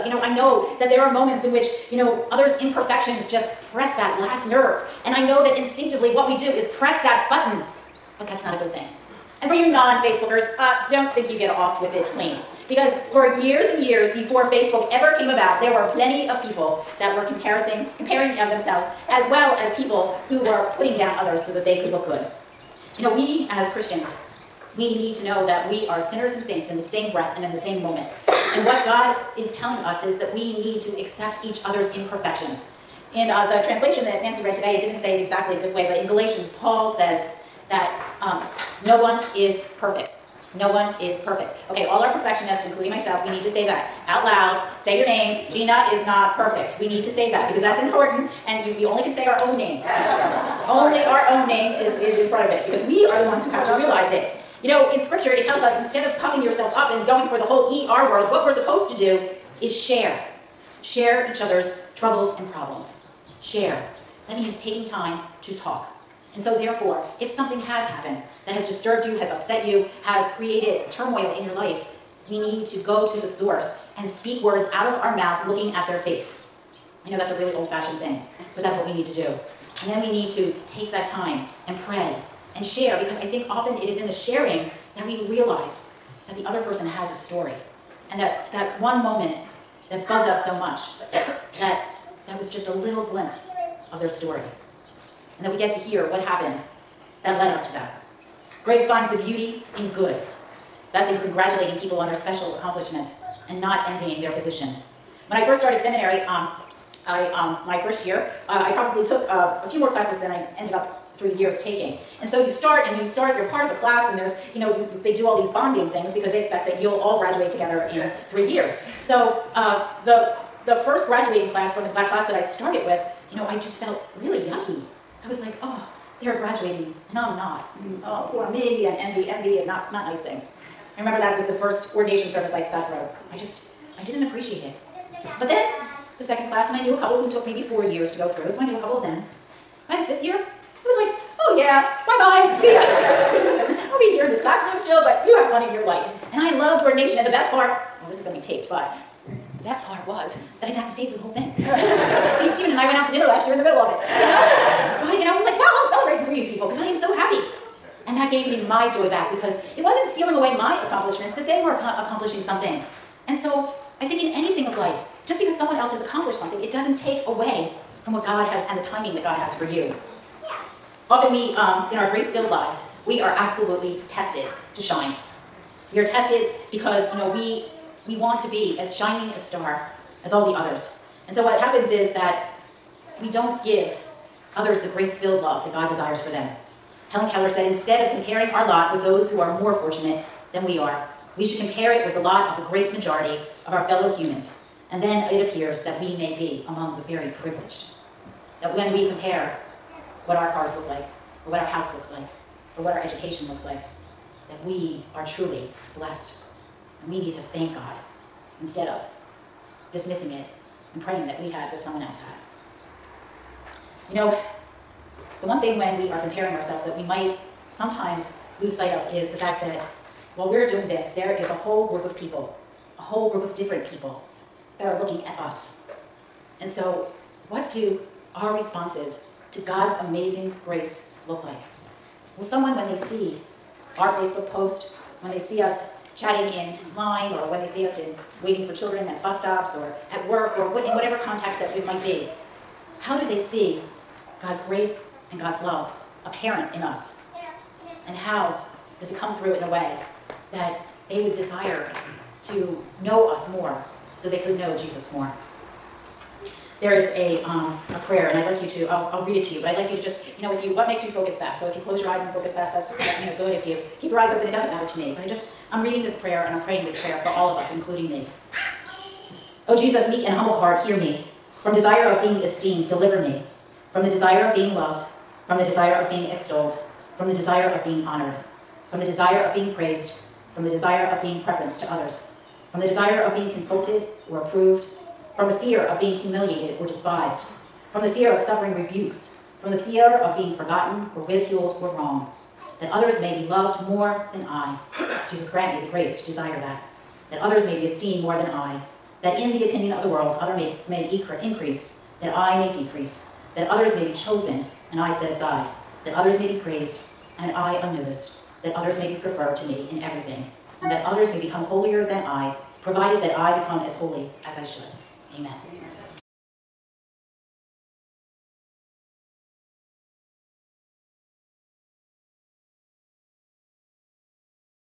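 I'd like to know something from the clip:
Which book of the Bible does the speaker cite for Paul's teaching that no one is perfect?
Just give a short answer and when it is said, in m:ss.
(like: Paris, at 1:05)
Galatians, at 0:36.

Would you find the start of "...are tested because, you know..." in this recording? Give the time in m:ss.
2:55.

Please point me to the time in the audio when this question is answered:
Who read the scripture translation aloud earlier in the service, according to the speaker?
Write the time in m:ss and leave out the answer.
0:34.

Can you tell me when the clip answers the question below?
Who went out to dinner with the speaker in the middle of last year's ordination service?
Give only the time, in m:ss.
2:32.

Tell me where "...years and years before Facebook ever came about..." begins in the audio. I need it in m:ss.
0:13.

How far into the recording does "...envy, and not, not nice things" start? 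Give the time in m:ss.
2:09.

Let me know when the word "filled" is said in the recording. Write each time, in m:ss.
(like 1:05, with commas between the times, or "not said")
2:52, 3:04.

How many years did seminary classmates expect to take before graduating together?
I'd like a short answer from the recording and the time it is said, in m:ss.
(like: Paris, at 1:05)
3, at 1:58.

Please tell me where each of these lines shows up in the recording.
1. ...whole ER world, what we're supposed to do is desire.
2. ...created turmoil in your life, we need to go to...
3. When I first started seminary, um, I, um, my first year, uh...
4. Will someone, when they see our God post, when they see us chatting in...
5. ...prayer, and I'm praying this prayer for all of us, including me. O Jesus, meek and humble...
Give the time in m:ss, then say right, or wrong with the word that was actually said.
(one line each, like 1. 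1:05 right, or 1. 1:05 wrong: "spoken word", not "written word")
1. 0:57 wrong: "share", not "desire"
2. 1:10 right
3. 1:45 right
4. 3:52 wrong: "Facebook", not "God"
5. 4:26 right.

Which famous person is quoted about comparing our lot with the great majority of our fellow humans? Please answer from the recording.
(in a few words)
Helen Keller.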